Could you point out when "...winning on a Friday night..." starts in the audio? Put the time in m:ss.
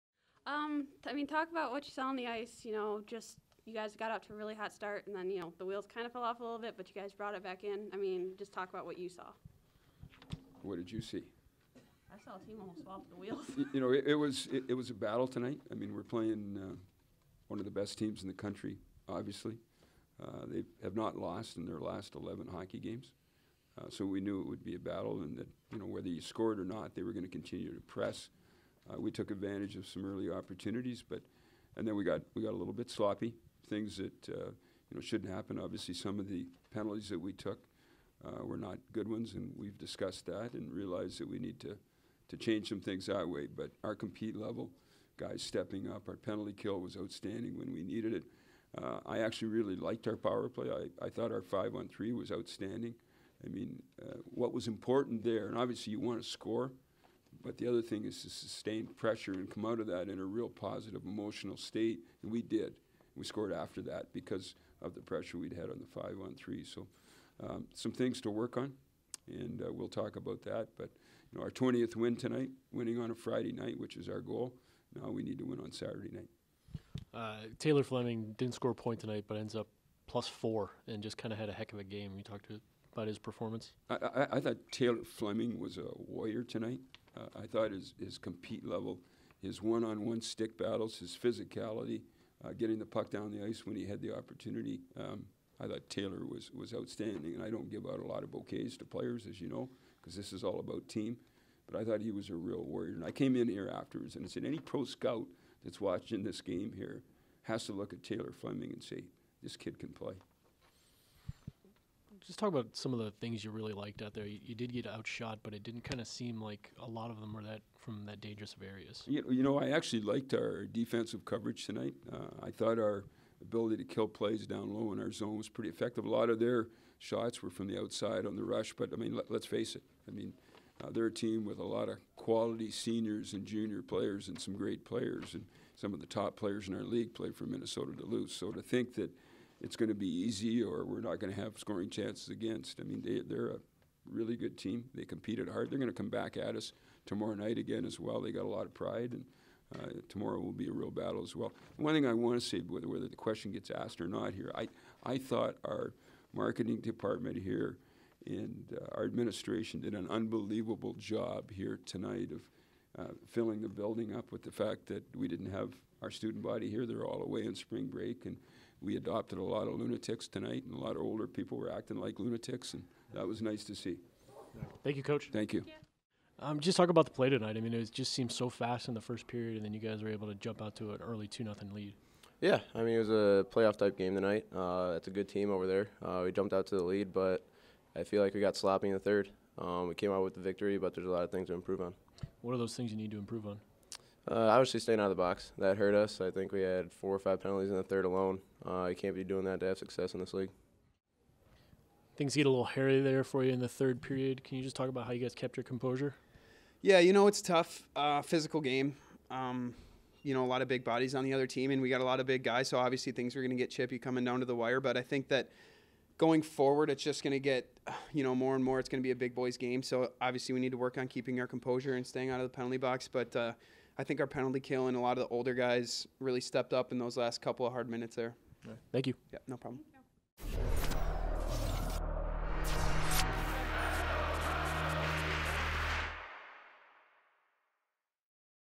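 1:12.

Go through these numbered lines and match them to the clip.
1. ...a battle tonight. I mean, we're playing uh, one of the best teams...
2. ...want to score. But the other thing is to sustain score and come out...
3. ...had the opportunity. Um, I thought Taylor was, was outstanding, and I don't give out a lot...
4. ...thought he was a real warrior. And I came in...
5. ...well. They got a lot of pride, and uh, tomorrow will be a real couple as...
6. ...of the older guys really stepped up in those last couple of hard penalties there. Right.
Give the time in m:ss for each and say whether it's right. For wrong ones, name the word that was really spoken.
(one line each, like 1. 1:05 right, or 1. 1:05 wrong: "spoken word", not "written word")
1. 0:14 right
2. 0:55 wrong: "pressure", not "score"
3. 1:33 right
4. 1:41 right
5. 2:27 wrong: "battle", not "couple"
6. 3:45 wrong: "minutes", not "penalties".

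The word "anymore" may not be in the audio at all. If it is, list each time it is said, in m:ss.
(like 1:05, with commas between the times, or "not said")
not said.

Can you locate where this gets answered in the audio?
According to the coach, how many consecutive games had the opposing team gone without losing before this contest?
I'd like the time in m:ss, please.
0:22.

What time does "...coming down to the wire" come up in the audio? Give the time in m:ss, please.
3:33.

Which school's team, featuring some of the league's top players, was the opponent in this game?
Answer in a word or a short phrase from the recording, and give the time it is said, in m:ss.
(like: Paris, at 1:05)
Minnesota Duluth, at 2:17.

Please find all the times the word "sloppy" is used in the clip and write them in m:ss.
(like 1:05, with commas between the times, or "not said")
0:32, 3:08.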